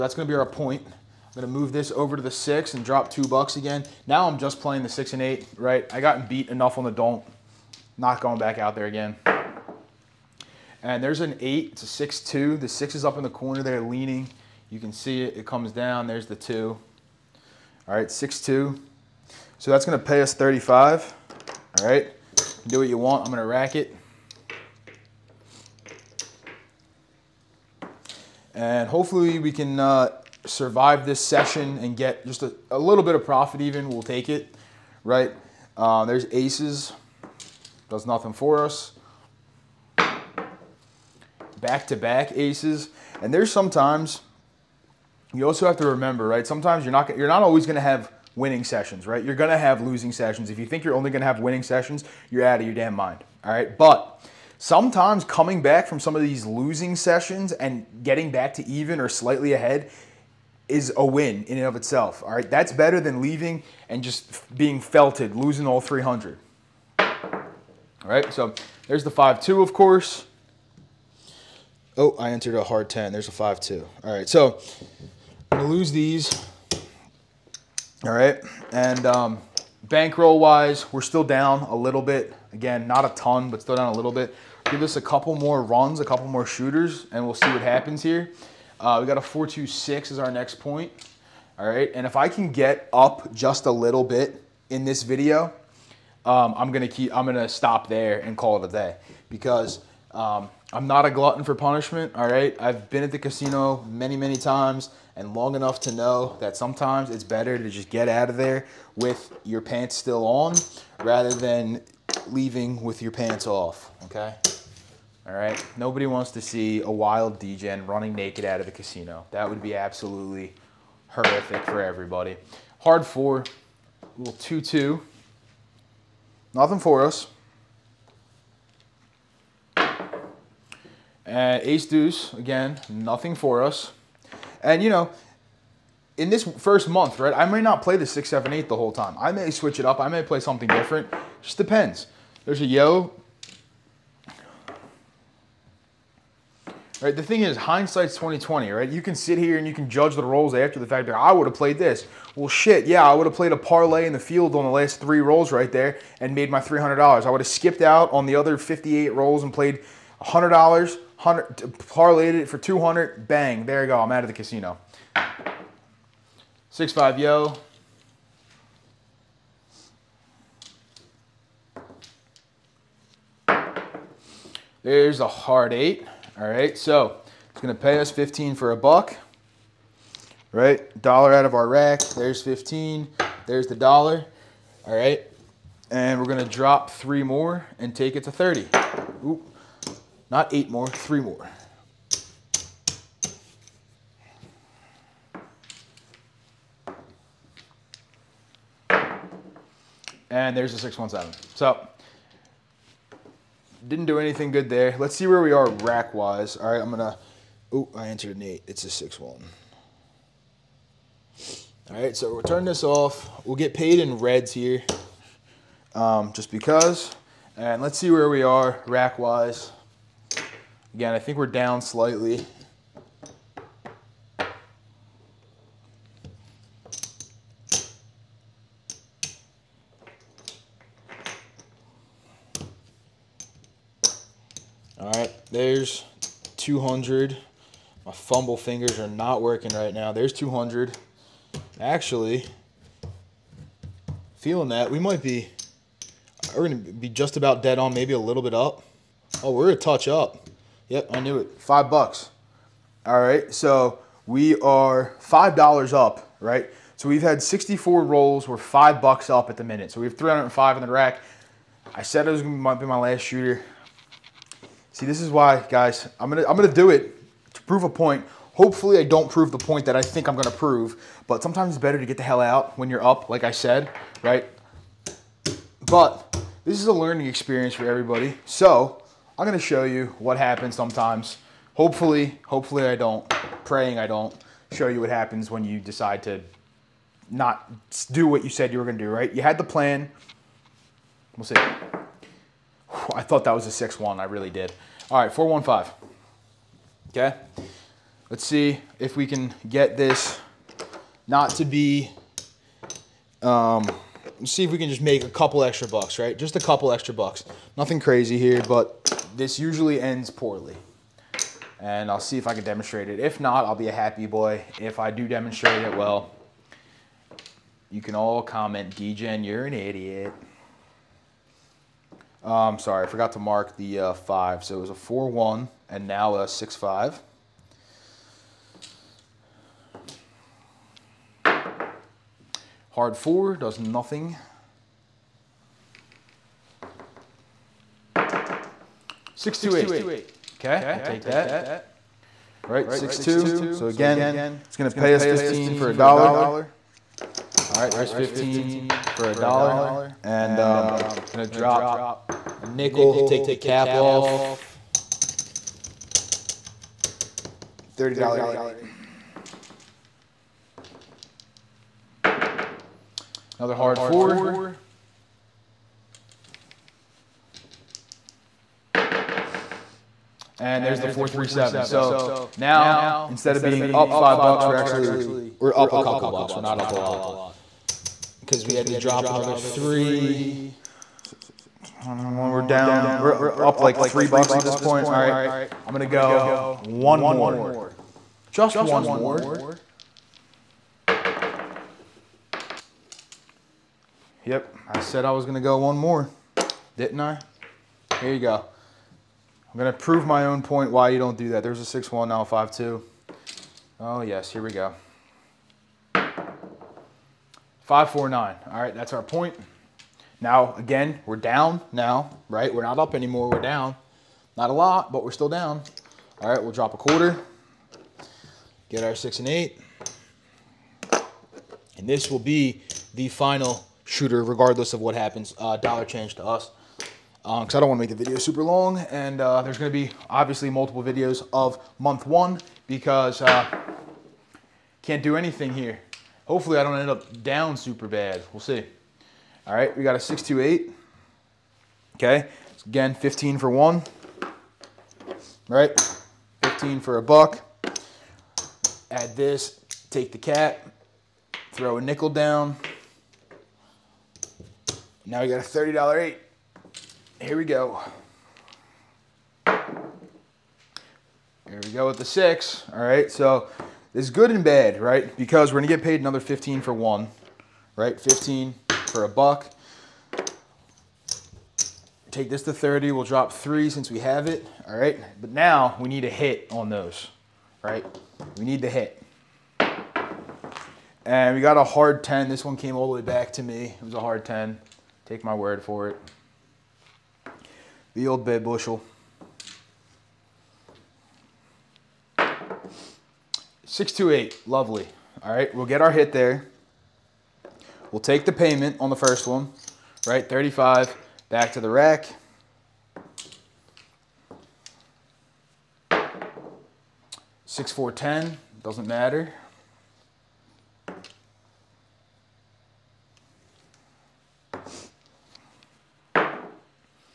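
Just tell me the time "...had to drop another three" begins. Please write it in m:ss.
6:18.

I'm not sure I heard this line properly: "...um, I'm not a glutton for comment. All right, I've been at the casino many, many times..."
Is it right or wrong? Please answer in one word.
wrong.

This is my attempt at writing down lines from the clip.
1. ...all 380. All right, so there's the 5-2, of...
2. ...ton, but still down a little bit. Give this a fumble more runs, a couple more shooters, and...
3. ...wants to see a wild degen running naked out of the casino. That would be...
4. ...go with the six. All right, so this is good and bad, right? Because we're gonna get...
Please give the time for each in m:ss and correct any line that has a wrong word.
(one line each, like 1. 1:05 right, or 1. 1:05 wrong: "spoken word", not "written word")
1. 1:05 wrong: "300", not "380"
2. 1:23 wrong: "couple", not "fumble"
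3. 1:56 right
4. 7:41 right.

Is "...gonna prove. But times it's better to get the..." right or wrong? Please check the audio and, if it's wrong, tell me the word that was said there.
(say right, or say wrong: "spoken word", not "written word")
wrong: "sometimes", not "times".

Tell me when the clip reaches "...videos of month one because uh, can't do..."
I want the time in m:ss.
7:11.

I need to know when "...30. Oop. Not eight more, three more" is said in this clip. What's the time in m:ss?
3:08.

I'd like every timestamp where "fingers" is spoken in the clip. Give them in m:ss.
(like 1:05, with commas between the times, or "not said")
3:58.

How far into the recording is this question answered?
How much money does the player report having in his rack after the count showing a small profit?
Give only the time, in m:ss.
4:20.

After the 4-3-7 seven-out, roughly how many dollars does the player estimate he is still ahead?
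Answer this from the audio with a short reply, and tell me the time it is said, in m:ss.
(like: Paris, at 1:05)
$3, at 6:23.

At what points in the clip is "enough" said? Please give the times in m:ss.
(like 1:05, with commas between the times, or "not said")
0:06, 1:45.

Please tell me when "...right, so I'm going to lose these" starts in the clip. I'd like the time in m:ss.
1:14.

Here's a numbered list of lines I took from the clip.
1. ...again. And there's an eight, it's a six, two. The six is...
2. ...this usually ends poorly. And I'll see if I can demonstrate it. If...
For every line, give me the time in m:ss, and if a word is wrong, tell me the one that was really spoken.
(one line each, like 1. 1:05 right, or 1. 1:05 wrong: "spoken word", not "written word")
1. 0:08 right
2. 5:09 right.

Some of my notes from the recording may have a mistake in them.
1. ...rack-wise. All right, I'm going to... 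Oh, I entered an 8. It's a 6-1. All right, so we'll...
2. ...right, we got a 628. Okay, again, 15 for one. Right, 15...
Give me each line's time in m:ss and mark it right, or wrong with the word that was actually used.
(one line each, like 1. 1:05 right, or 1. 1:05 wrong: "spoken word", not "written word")
1. 3:25 right
2. 7:19 right.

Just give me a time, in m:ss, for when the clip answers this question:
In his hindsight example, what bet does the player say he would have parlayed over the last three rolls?
2:34.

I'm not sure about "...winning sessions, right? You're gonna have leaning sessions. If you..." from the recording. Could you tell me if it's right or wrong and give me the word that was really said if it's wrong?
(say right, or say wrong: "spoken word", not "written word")
wrong: "losing", not "leaning".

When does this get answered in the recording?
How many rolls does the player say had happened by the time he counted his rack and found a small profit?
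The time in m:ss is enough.
4:17.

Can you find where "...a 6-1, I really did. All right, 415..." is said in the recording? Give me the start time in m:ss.
4:53.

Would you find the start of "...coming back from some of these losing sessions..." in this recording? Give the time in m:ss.
0:55.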